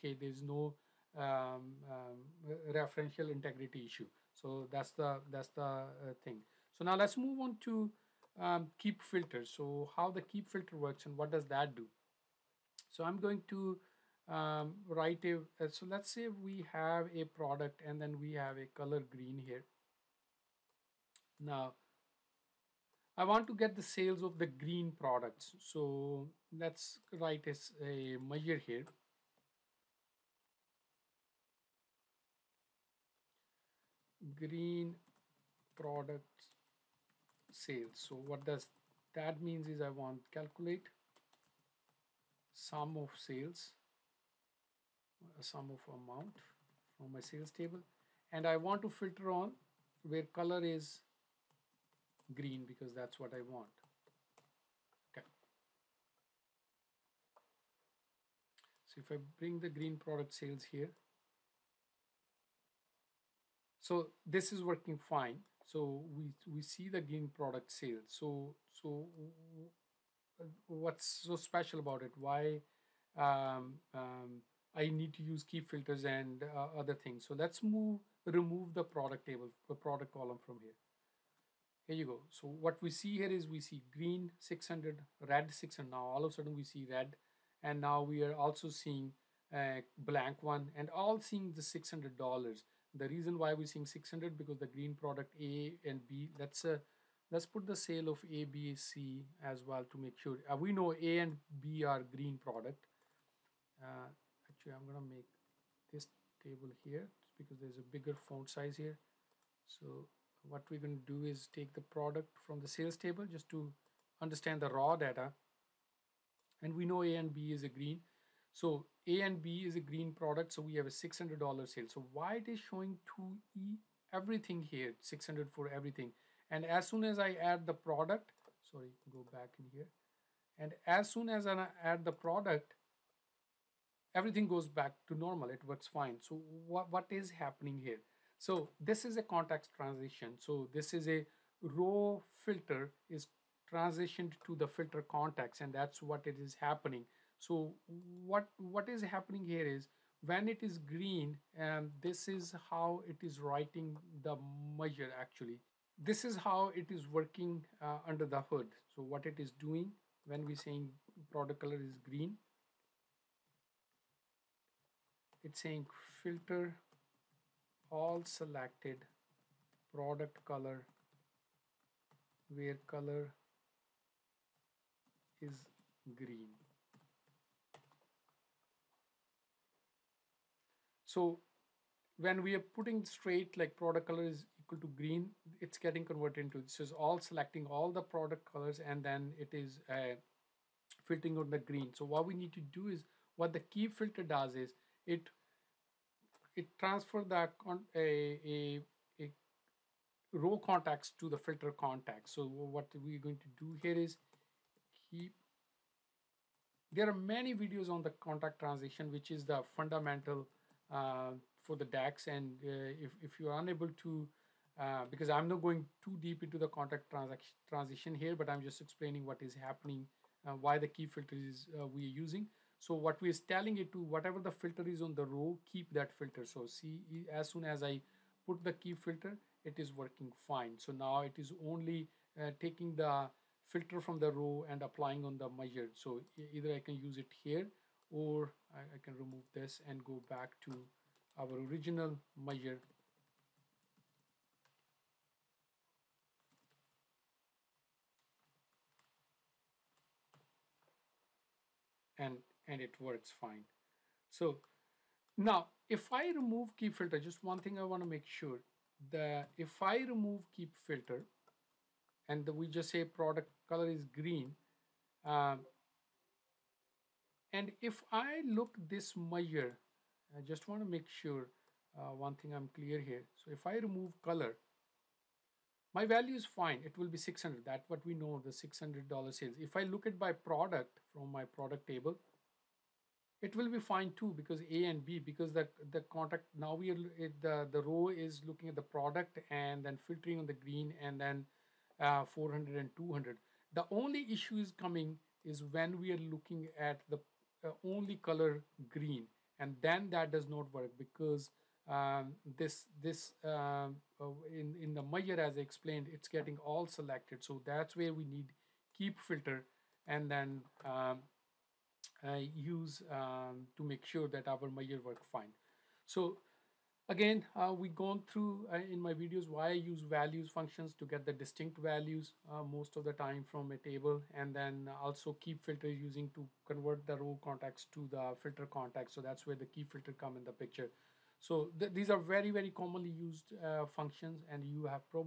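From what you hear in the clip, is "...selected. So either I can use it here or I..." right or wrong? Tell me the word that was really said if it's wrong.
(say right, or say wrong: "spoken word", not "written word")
wrong: "measured", not "selected".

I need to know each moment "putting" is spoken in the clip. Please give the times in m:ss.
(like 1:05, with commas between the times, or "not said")
3:02.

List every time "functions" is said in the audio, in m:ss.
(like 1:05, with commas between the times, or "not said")
5:20, 5:33.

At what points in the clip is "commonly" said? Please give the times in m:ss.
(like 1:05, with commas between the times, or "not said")
5:32.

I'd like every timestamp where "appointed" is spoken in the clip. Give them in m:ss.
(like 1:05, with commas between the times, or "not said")
not said.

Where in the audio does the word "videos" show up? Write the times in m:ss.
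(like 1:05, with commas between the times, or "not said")
3:27, 5:19.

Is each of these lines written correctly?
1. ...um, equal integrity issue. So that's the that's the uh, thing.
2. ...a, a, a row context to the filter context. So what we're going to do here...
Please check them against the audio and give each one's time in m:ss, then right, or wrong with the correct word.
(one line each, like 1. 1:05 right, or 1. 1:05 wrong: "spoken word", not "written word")
1. 0:01 wrong: "referential", not "equal"
2. 3:17 right.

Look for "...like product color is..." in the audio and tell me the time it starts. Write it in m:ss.
3:03.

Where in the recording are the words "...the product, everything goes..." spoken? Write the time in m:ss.
2:12.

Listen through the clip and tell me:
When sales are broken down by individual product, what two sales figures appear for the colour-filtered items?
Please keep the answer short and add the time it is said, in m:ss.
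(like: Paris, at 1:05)
400 and 200, at 4:52.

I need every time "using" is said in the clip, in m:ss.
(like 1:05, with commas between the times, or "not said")
3:42, 5:25.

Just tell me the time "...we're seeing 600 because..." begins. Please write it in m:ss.
1:33.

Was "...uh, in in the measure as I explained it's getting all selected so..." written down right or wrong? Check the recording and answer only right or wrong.
right.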